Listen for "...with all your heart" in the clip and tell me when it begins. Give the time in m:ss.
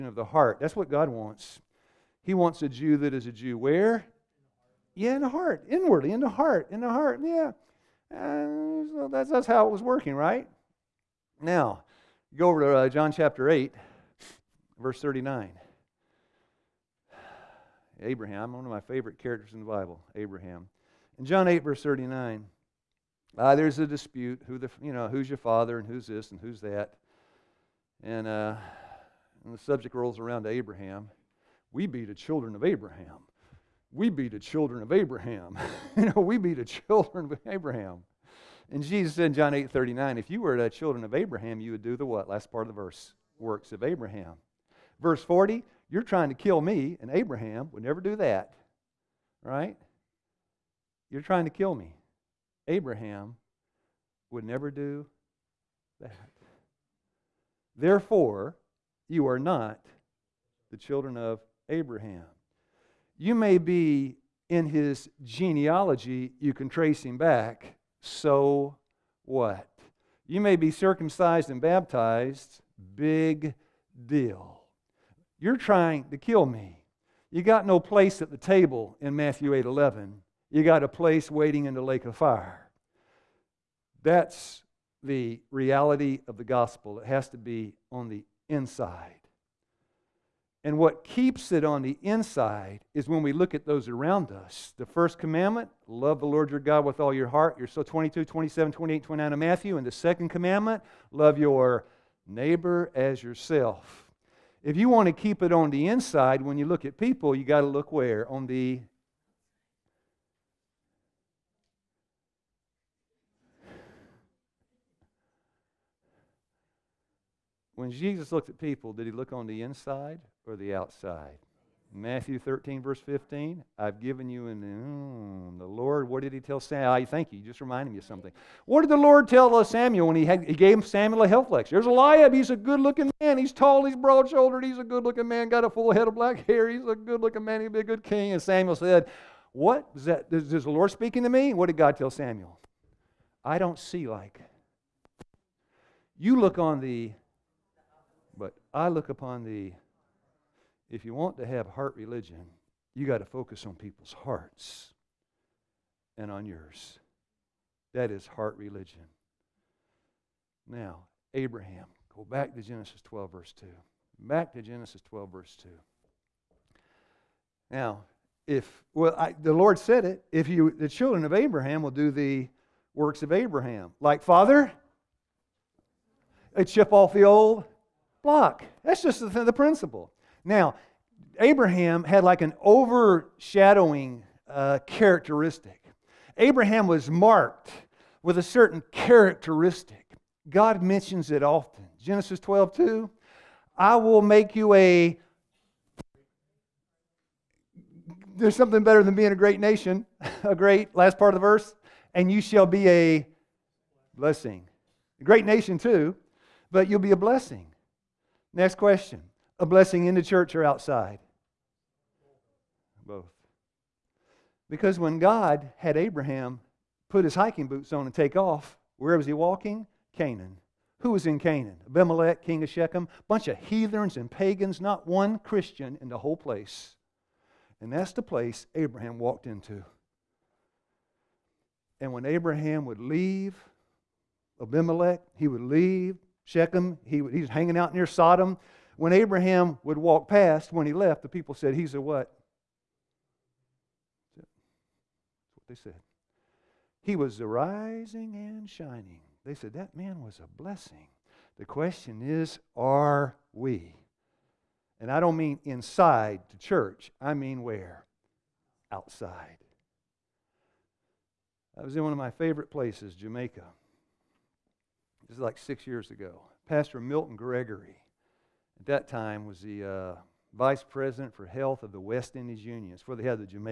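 1:36.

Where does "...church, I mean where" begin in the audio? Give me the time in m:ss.
4:16.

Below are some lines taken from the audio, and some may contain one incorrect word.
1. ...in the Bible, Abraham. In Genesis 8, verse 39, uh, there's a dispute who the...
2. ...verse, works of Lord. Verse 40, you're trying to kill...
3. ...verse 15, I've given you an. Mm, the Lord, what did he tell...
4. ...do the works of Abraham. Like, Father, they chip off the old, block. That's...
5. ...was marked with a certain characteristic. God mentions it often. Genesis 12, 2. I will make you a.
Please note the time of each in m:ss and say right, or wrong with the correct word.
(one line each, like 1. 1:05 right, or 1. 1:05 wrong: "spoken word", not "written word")
1. 0:19 wrong: "John", not "Genesis"
2. 0:42 wrong: "Abraham", not "Lord"
3. 2:02 right
4. 2:51 right
5. 3:06 right.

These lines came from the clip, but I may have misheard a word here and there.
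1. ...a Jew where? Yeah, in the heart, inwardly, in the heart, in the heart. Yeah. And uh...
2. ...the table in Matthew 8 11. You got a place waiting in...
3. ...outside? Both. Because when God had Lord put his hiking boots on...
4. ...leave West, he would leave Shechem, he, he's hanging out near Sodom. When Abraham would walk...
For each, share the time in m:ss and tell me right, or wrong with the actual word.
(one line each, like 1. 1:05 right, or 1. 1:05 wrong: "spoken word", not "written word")
1. 0:03 right
2. 1:18 right
3. 3:30 wrong: "Abraham", not "Lord"
4. 3:52 wrong: "Abimelech", not "West".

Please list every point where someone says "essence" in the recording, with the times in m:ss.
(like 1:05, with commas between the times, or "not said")
not said.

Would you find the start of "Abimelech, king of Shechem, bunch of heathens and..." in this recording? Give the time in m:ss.
3:41.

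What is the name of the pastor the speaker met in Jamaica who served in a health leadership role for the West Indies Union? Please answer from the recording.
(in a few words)
Milton Gregory.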